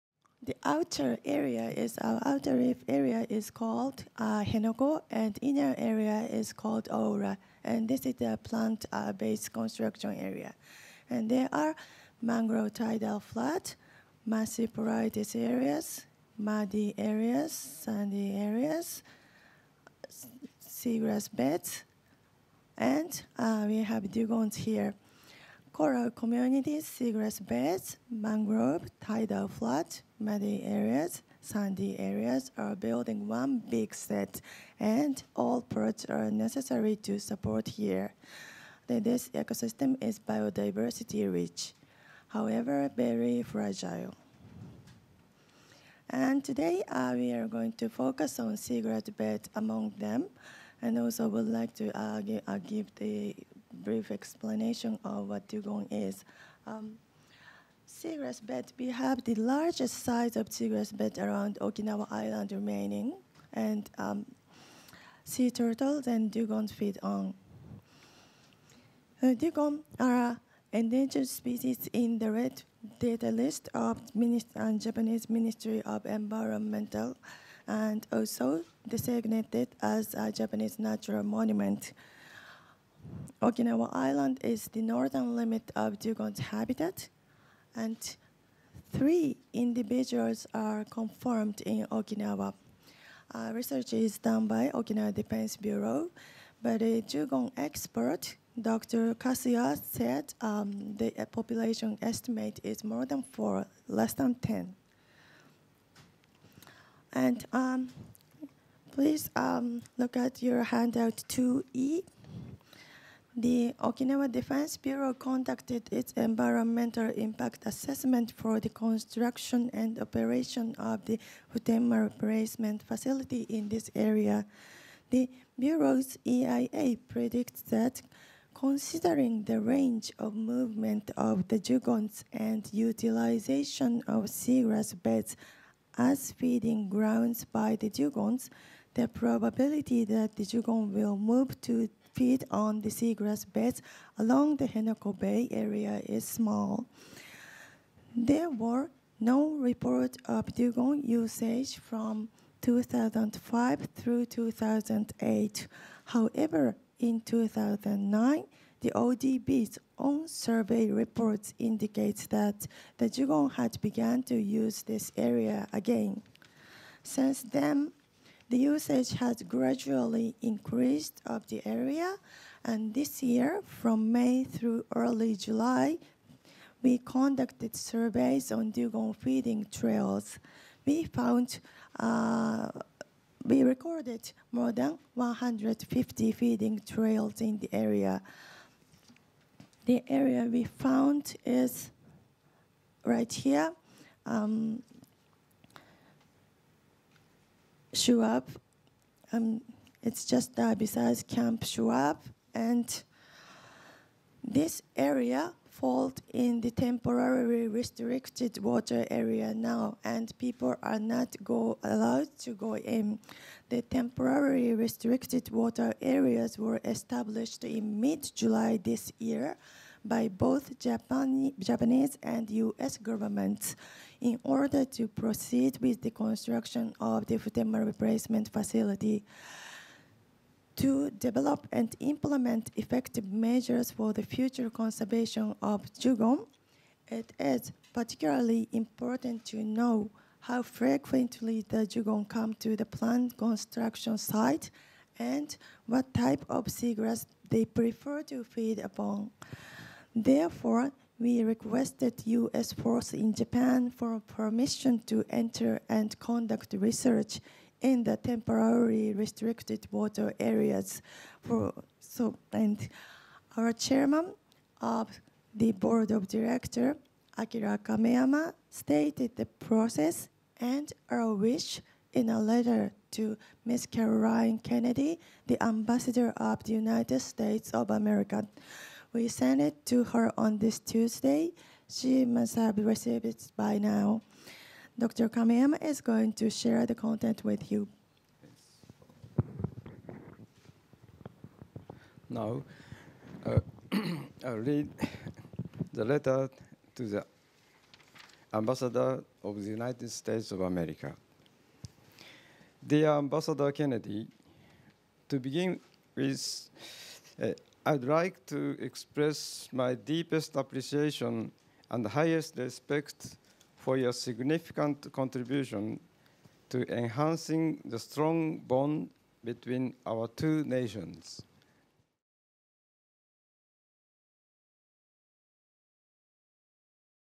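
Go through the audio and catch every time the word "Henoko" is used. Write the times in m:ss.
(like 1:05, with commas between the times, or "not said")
0:04, 2:24.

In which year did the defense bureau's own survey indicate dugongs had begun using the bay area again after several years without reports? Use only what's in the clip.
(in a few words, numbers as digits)
2009.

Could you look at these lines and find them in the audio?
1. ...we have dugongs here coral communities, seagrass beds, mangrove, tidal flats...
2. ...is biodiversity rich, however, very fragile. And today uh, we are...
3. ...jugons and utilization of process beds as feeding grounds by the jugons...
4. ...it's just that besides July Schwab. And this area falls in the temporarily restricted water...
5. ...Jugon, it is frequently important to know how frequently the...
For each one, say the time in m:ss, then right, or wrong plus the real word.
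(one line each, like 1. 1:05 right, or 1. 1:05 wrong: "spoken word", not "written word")
1. 0:23 right
2. 0:40 right
3. 2:11 wrong: "seagrass", not "process"
4. 3:20 wrong: "Camp", not "July"
5. 3:55 wrong: "particularly", not "frequently".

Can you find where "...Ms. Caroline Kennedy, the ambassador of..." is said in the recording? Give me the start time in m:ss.
4:33.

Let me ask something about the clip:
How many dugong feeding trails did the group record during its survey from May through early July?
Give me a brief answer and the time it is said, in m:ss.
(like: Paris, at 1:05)
more than 150, at 3:04.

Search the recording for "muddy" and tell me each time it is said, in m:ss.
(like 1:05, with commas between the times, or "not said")
0:16, 0:30.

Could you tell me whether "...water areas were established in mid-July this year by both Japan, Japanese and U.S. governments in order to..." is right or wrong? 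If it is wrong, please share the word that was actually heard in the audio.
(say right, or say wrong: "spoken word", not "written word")
right.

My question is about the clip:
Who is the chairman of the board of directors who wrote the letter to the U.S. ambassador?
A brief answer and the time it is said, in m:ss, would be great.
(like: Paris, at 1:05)
Akira Kameyama, at 4:27.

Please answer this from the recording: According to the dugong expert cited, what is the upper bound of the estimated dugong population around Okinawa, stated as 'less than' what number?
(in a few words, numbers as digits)
10.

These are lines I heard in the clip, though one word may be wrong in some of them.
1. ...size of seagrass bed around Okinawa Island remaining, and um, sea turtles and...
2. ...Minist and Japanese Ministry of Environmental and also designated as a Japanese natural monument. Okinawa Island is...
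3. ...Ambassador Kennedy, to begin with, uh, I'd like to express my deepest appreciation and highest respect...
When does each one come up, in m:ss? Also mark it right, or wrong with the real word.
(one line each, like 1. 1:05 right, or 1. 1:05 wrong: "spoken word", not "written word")
1. 1:00 right
2. 1:14 right
3. 5:03 right.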